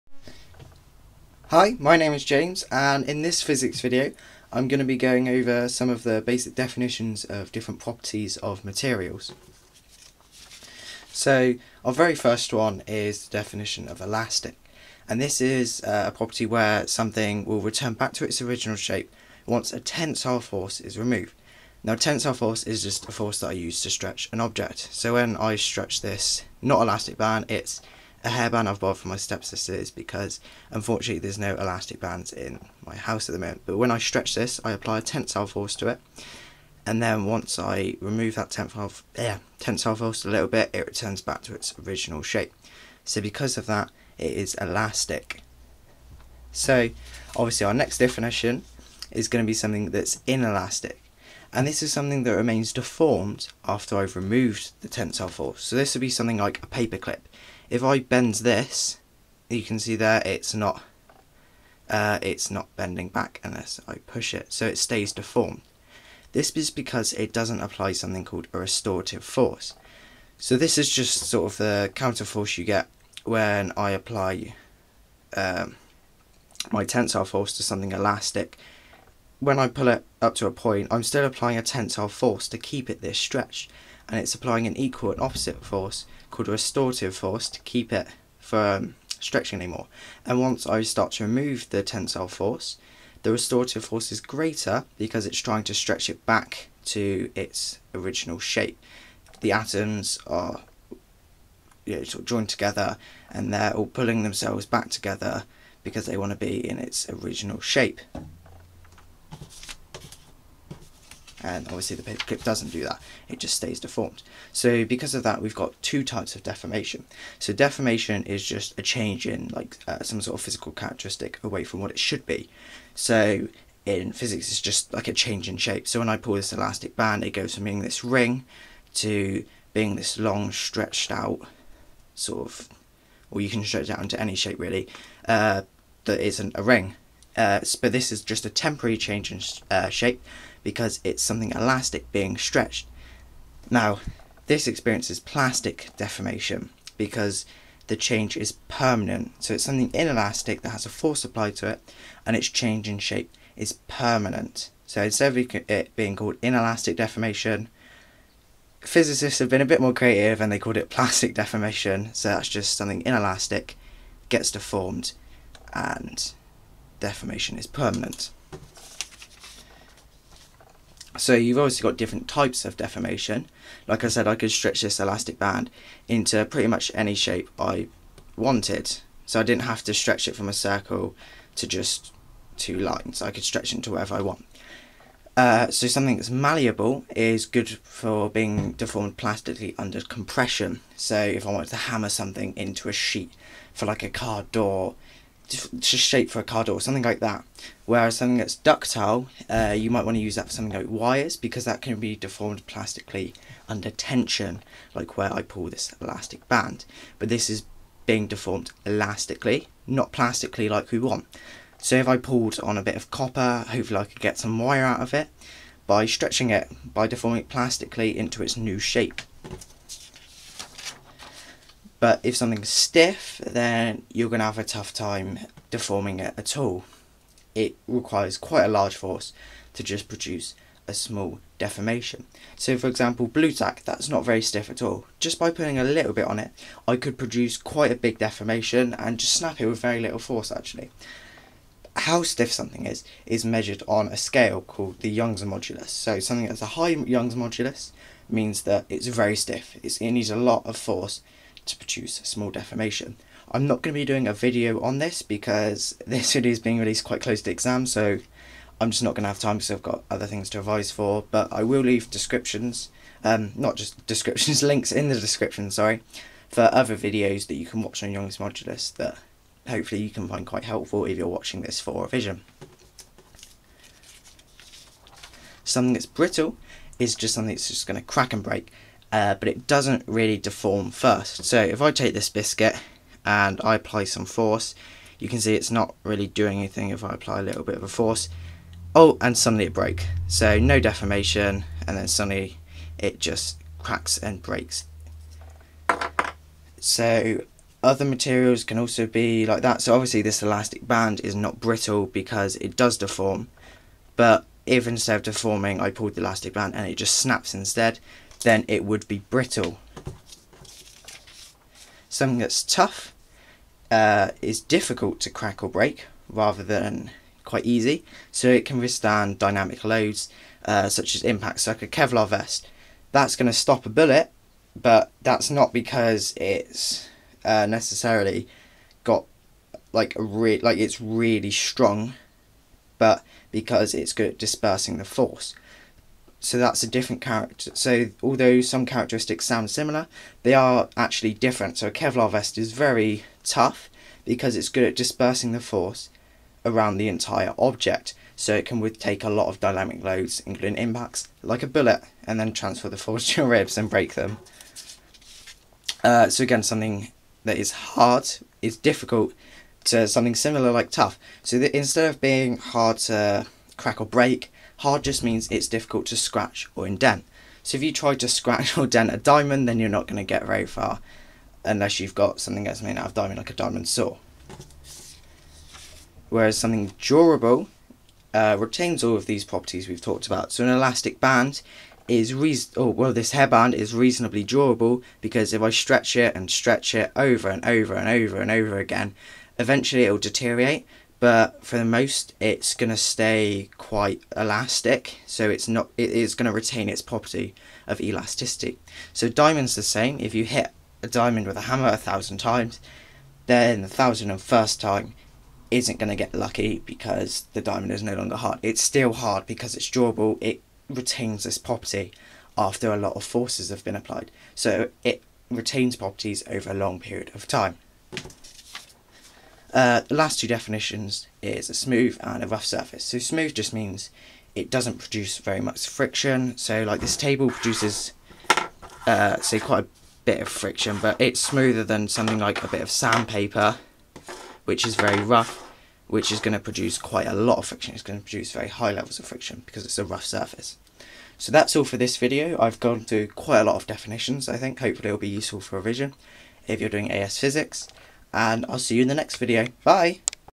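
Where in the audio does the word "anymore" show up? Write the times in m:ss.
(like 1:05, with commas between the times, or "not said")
1:29.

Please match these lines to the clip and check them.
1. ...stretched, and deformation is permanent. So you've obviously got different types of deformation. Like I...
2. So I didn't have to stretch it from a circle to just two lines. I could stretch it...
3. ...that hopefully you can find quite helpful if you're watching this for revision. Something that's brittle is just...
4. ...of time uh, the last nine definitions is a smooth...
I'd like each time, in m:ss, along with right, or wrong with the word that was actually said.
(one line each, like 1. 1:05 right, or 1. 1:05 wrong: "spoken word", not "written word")
1. 2:44 wrong: "deformed", not "stretched"
2. 2:59 right
3. 4:28 right
4. 6:57 wrong: "two", not "nine".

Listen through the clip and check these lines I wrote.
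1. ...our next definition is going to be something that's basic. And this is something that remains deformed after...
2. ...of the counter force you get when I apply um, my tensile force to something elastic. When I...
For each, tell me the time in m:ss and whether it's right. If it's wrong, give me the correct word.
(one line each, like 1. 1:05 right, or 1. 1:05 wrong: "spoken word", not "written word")
1. 0:47 wrong: "inelastic", not "basic"
2. 1:11 right.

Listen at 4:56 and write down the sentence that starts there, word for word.
So other materials can also be like that.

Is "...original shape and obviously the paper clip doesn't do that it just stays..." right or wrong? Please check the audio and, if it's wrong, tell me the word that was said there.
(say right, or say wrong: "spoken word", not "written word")
right.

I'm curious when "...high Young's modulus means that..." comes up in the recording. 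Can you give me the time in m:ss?
4:06.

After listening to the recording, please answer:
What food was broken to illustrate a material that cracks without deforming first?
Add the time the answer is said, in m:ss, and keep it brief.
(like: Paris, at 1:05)
biscuit, at 4:42.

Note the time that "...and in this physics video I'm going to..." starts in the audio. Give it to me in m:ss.
0:02.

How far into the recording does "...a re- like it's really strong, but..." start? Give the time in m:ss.
5:30.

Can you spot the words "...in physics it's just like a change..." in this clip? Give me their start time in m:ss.
2:03.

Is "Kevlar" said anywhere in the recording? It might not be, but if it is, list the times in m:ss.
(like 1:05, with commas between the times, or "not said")
5:21, 5:41.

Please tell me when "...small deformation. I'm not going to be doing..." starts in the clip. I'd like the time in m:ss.
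4:12.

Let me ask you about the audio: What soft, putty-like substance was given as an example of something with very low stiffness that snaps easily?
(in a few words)
Blu-tack.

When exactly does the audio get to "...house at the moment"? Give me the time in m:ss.
0:32.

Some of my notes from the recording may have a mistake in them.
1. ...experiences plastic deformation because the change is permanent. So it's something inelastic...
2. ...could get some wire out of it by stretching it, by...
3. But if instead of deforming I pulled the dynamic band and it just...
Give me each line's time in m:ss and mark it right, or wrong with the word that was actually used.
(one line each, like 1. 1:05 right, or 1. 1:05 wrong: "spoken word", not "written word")
1. 2:24 right
2. 3:34 right
3. 5:04 wrong: "elastic", not "dynamic".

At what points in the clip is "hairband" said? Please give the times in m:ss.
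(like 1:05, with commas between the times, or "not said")
0:28, 6:23.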